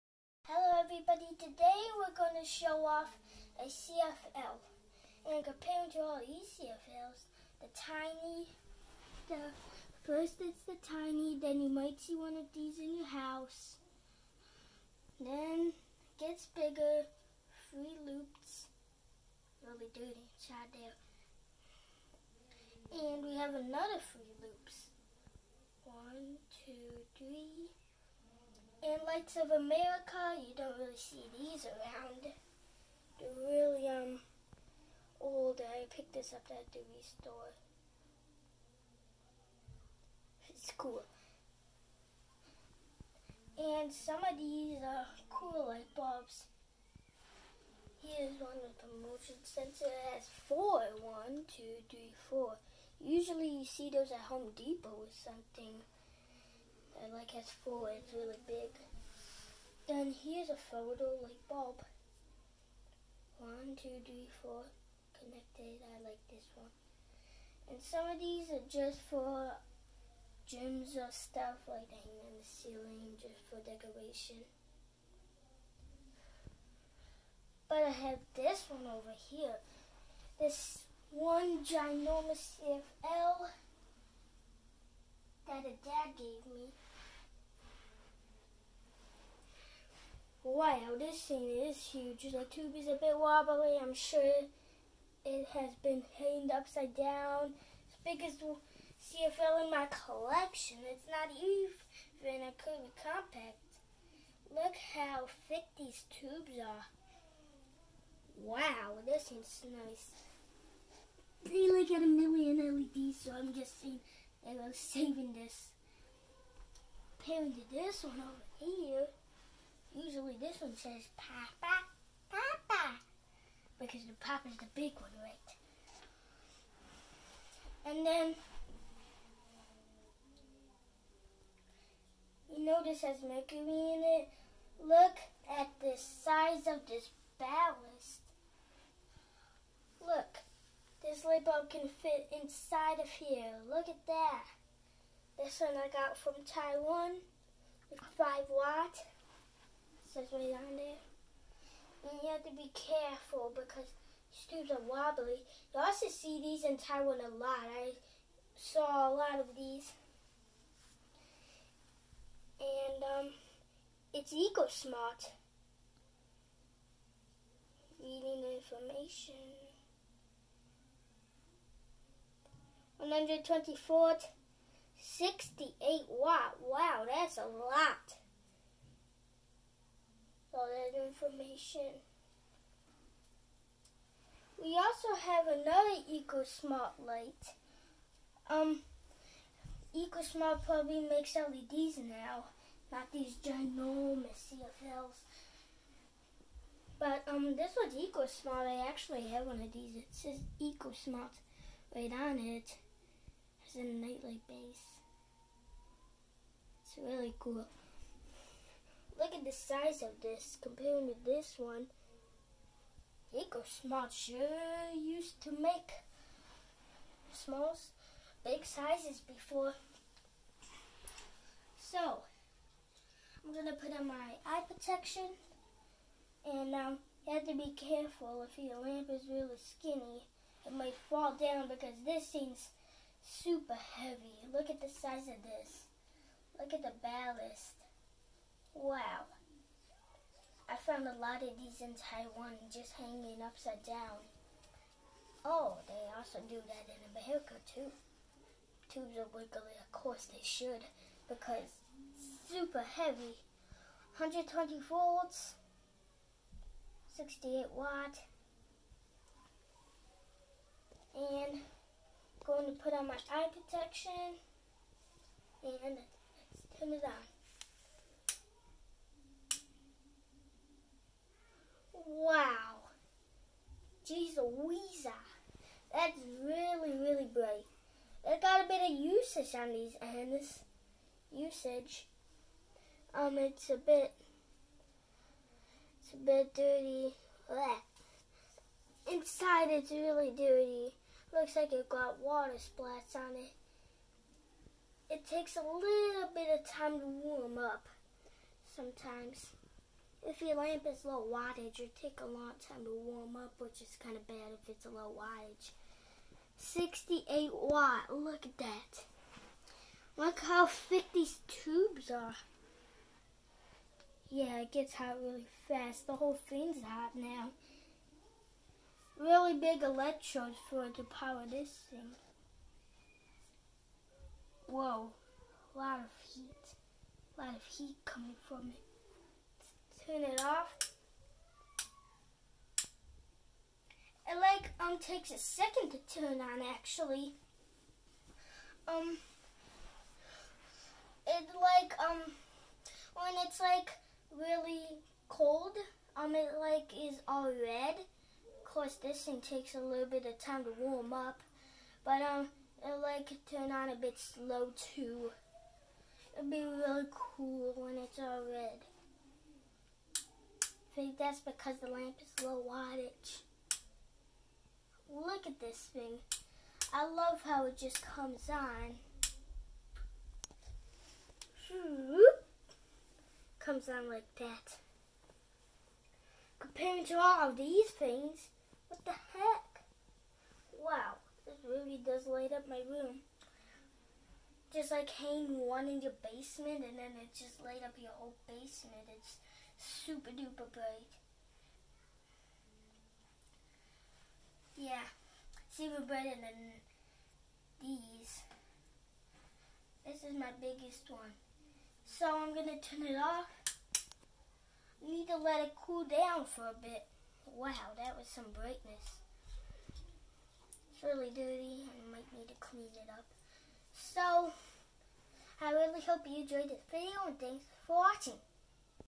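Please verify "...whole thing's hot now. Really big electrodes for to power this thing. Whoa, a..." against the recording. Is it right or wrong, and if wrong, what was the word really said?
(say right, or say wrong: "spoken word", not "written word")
right.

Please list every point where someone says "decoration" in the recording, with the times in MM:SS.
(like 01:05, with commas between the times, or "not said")
01:13.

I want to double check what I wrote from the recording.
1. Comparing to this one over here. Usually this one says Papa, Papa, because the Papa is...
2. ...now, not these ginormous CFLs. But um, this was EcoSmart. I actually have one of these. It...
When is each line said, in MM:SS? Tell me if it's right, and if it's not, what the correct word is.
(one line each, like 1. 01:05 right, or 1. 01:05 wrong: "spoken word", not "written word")
1. 01:57 right
2. 03:11 right.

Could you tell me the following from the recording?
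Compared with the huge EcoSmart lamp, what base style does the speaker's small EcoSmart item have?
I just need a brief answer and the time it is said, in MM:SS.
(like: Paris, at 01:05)
nightlight base, at 03:23.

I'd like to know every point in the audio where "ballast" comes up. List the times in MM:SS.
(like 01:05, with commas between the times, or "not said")
02:17, 03:57.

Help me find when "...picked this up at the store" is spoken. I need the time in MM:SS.
00:35.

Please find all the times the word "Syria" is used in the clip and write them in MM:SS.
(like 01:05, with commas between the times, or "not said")
not said.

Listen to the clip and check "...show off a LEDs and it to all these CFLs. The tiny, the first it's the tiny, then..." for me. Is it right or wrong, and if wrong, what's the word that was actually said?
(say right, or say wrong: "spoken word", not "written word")
wrong: "CFL", not "LEDs".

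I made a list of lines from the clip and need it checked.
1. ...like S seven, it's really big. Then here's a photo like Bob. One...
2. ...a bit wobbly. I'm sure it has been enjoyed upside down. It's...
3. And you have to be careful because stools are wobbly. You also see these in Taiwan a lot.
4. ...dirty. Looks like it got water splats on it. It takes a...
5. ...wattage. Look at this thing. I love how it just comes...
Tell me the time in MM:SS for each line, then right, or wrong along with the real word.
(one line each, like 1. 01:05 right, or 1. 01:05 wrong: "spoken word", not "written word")
1. 00:57 wrong: "four", not "seven"
2. 01:32 wrong: "hanged", not "enjoyed"
3. 02:32 right
4. 04:50 right
5. 06:02 right.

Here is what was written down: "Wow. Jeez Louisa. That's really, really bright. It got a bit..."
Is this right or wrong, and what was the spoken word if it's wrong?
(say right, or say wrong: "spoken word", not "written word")
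right.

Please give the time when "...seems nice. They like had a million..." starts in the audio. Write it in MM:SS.
01:49.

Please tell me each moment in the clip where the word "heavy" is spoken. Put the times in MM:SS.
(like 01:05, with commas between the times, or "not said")
03:53, 04:12.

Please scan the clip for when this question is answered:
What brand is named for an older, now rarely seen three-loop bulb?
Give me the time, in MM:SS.
00:29.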